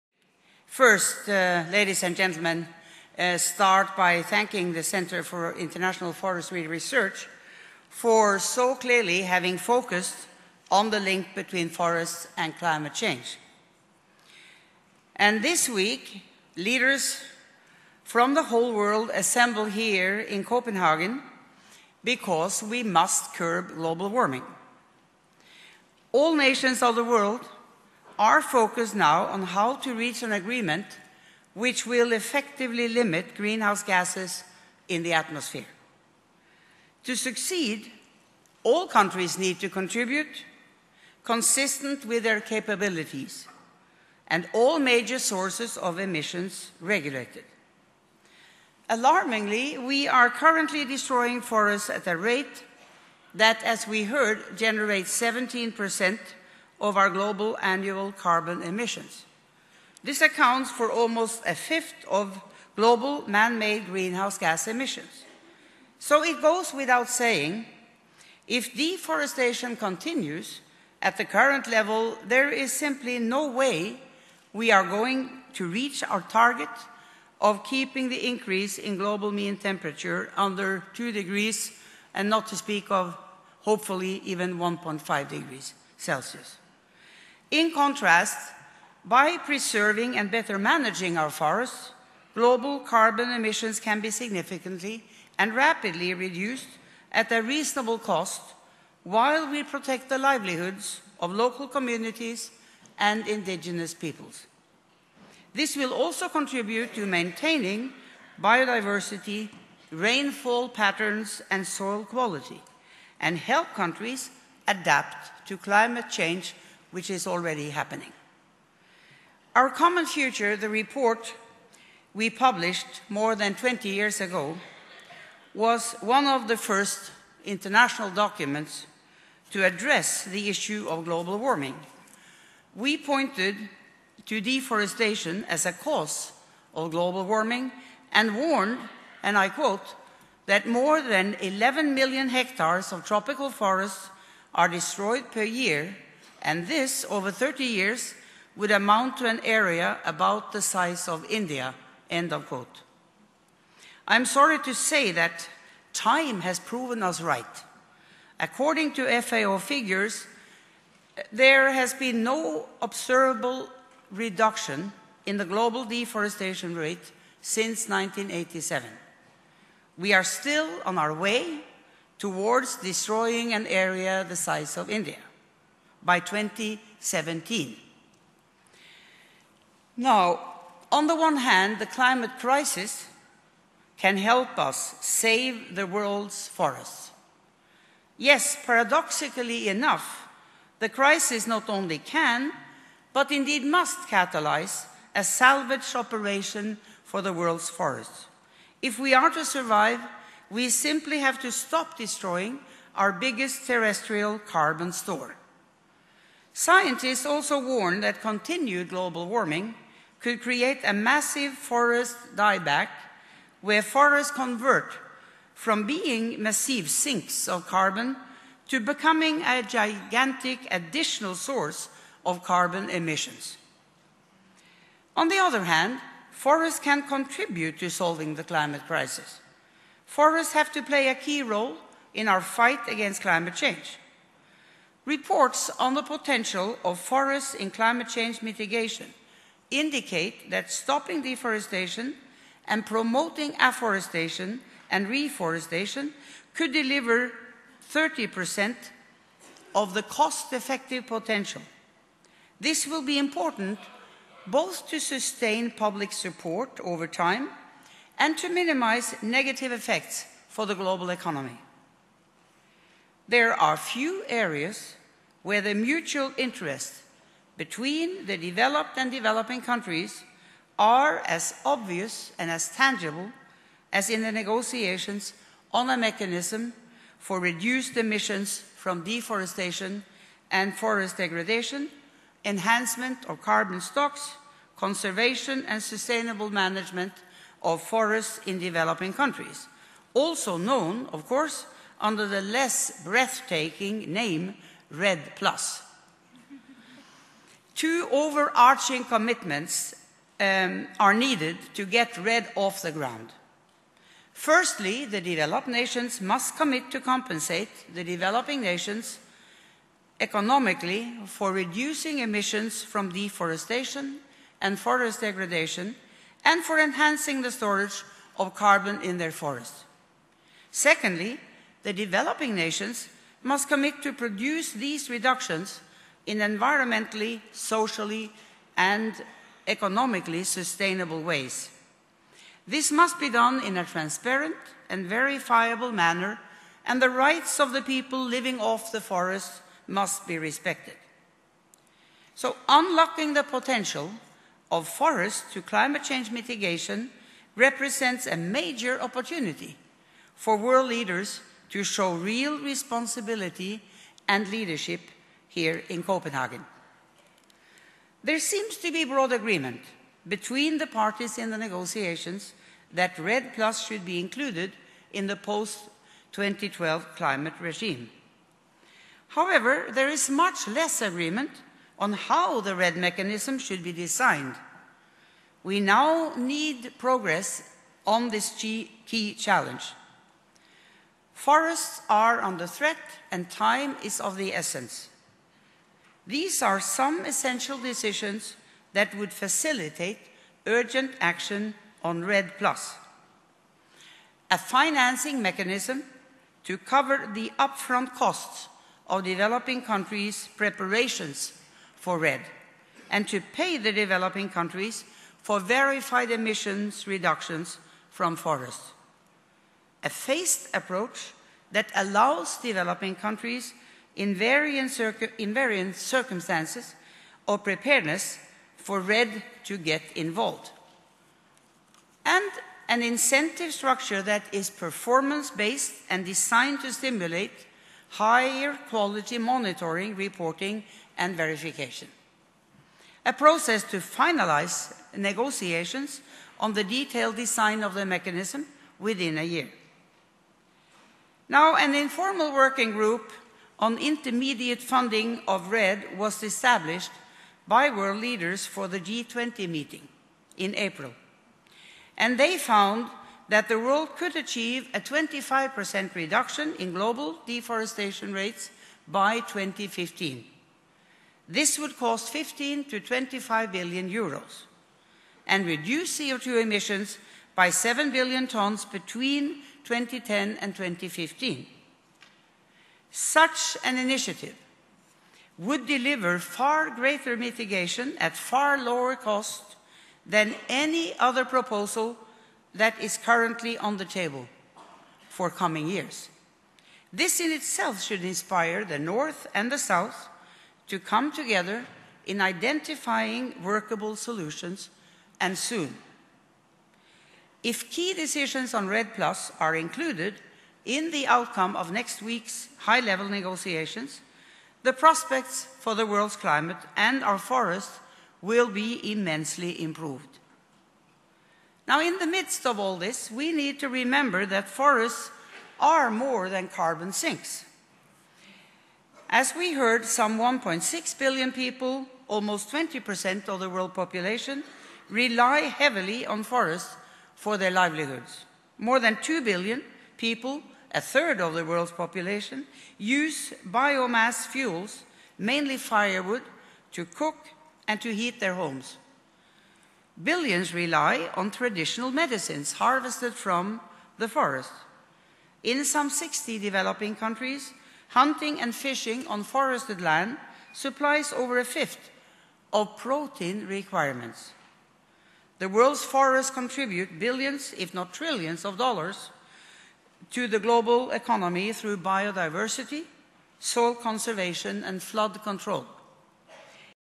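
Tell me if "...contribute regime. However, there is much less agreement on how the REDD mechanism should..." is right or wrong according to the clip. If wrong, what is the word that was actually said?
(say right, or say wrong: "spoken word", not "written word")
wrong: "climate", not "contribute".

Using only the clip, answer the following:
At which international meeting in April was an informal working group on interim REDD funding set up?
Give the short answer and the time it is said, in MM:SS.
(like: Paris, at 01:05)
G20, at 07:29.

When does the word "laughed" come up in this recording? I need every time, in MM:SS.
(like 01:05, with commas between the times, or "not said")
not said.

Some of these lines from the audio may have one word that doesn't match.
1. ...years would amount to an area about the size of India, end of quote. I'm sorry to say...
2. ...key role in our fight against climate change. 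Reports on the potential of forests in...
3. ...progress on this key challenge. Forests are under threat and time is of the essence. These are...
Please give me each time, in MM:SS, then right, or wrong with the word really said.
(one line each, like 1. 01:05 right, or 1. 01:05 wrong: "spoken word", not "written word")
1. 02:27 right
2. 03:51 right
3. 06:16 right.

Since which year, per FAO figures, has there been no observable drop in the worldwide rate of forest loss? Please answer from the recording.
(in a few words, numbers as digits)
1987.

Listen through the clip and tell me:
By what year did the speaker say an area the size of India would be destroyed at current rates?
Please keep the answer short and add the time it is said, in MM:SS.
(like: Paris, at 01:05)
2017, at 02:56.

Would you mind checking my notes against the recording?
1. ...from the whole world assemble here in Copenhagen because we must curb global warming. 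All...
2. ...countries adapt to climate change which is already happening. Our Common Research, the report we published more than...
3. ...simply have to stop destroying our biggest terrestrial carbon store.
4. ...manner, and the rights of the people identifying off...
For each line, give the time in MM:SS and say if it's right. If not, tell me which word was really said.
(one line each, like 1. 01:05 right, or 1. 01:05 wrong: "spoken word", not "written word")
1. 00:18 right
2. 01:53 wrong: "Future", not "Research"
3. 03:20 right
4. 05:35 wrong: "living", not "identifying".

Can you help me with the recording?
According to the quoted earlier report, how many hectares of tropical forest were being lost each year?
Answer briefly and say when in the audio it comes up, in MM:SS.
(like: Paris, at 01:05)
More than 11 million, at 02:20.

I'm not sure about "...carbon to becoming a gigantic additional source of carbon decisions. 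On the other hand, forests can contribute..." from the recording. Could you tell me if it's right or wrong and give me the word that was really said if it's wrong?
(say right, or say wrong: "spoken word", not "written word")
wrong: "emissions", not "decisions".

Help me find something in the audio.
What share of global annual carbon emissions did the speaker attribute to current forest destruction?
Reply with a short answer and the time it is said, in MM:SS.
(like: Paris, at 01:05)
17 percent, at 00:55.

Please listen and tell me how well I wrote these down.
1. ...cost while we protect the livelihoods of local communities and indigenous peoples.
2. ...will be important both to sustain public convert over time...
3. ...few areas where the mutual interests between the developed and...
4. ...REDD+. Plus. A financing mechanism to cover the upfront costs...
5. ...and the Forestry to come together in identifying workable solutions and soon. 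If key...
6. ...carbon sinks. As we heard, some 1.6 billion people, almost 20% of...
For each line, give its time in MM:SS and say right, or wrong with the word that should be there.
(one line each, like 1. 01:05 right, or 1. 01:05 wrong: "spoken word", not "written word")
1. 01:37 right
2. 04:12 wrong: "support", not "convert"
3. 04:23 right
4. 06:32 right
5. 08:09 wrong: "South", not "Forestry"
6. 08:36 right.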